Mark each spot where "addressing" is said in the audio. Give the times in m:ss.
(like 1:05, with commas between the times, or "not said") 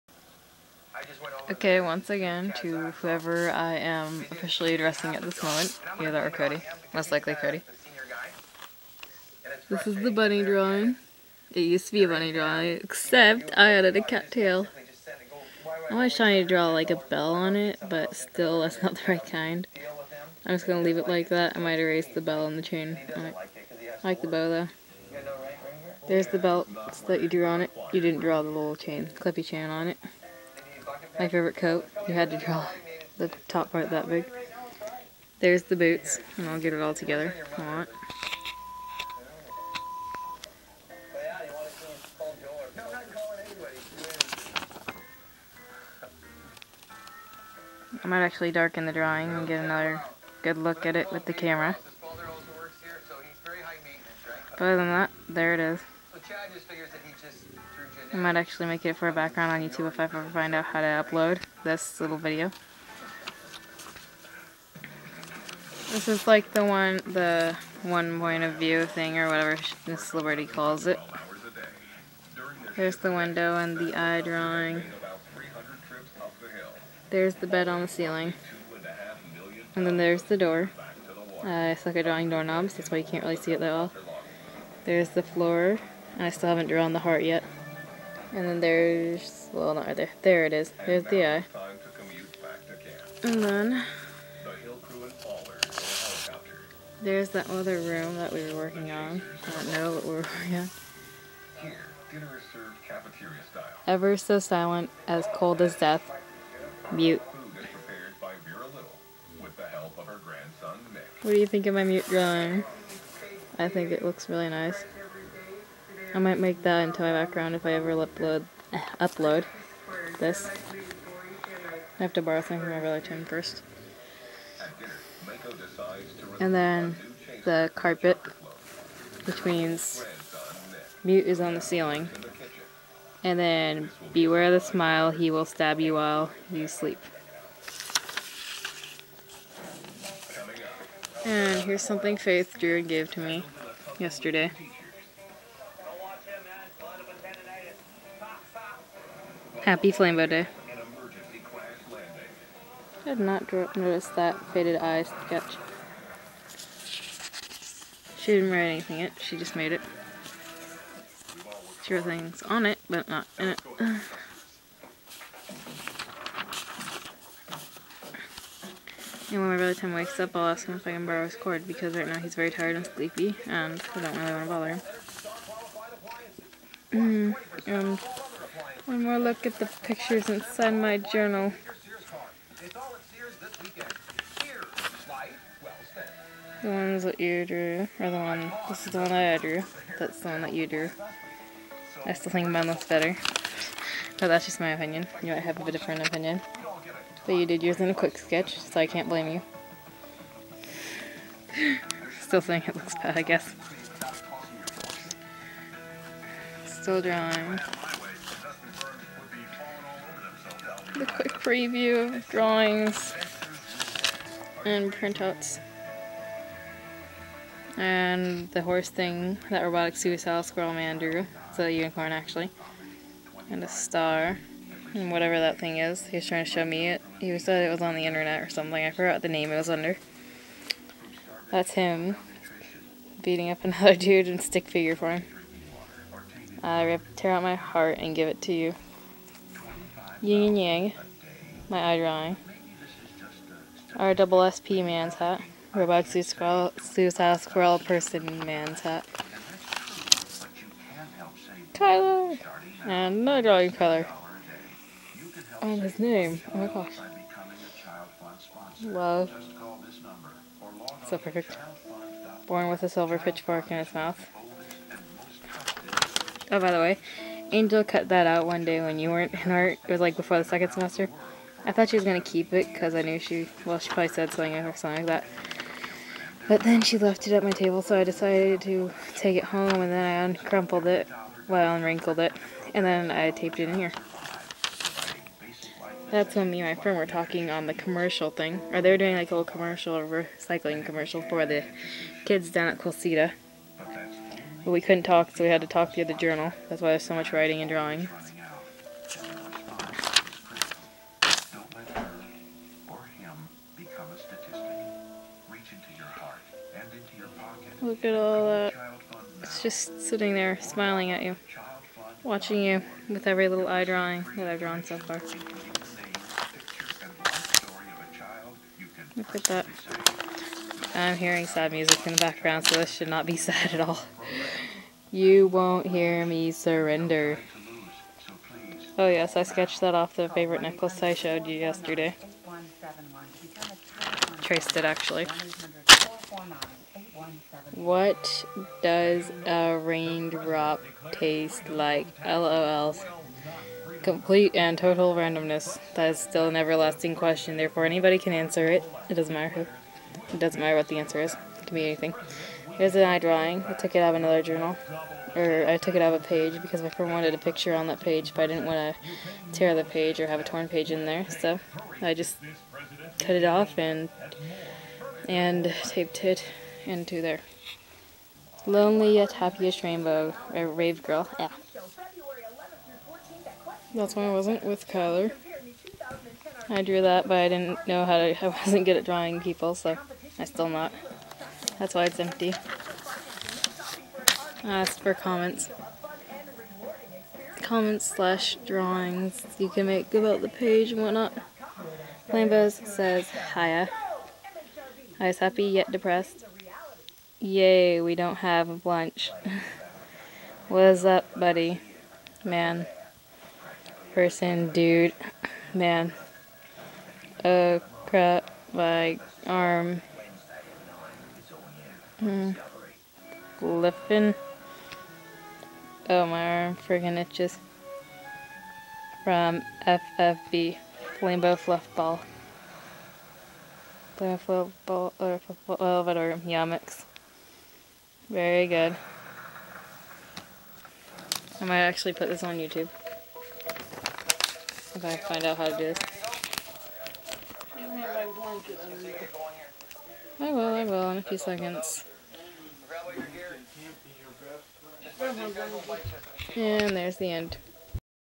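0:04.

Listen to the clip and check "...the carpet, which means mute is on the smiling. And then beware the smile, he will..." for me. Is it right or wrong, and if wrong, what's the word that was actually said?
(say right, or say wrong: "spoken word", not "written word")
wrong: "ceiling", not "smiling".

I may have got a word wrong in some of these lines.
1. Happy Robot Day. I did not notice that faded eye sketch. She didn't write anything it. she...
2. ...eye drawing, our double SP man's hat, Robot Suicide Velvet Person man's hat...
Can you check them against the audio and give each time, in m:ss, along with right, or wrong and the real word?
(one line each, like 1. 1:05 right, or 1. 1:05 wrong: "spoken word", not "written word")
1. 2:29 wrong: "Flambo", not "Robot"
2. 4:01 wrong: "Squirrel", not "Velvet".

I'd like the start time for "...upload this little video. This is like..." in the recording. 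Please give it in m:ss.
1:01.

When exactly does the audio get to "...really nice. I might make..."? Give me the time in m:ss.
1:54.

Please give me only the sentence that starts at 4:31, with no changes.
I thought she was going to keep it because I knew she, well, she probably said something or something like that.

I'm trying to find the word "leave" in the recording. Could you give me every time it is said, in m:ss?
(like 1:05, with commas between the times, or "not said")
0:20.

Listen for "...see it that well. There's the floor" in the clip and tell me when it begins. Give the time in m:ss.
1:23.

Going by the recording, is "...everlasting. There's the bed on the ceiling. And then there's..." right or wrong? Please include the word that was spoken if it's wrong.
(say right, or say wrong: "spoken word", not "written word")
wrong: "drawing", not "everlasting".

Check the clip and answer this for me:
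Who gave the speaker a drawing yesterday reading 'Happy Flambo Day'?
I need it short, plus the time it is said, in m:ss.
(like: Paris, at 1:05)
Faith, at 2:22.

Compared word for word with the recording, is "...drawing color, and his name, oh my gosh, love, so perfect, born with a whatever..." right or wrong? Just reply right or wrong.
wrong.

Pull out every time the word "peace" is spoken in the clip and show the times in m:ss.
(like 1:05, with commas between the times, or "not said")
not said.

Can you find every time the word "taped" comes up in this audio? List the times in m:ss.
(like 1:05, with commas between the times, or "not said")
4:43, 6:05.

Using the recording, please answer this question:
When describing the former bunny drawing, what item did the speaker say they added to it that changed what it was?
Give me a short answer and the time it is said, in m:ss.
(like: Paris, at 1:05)
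A cattail, at 0:14.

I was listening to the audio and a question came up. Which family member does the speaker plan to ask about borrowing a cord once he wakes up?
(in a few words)
Tim.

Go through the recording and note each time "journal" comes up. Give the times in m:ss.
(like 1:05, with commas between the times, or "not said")
3:00, 4:56, 5:54.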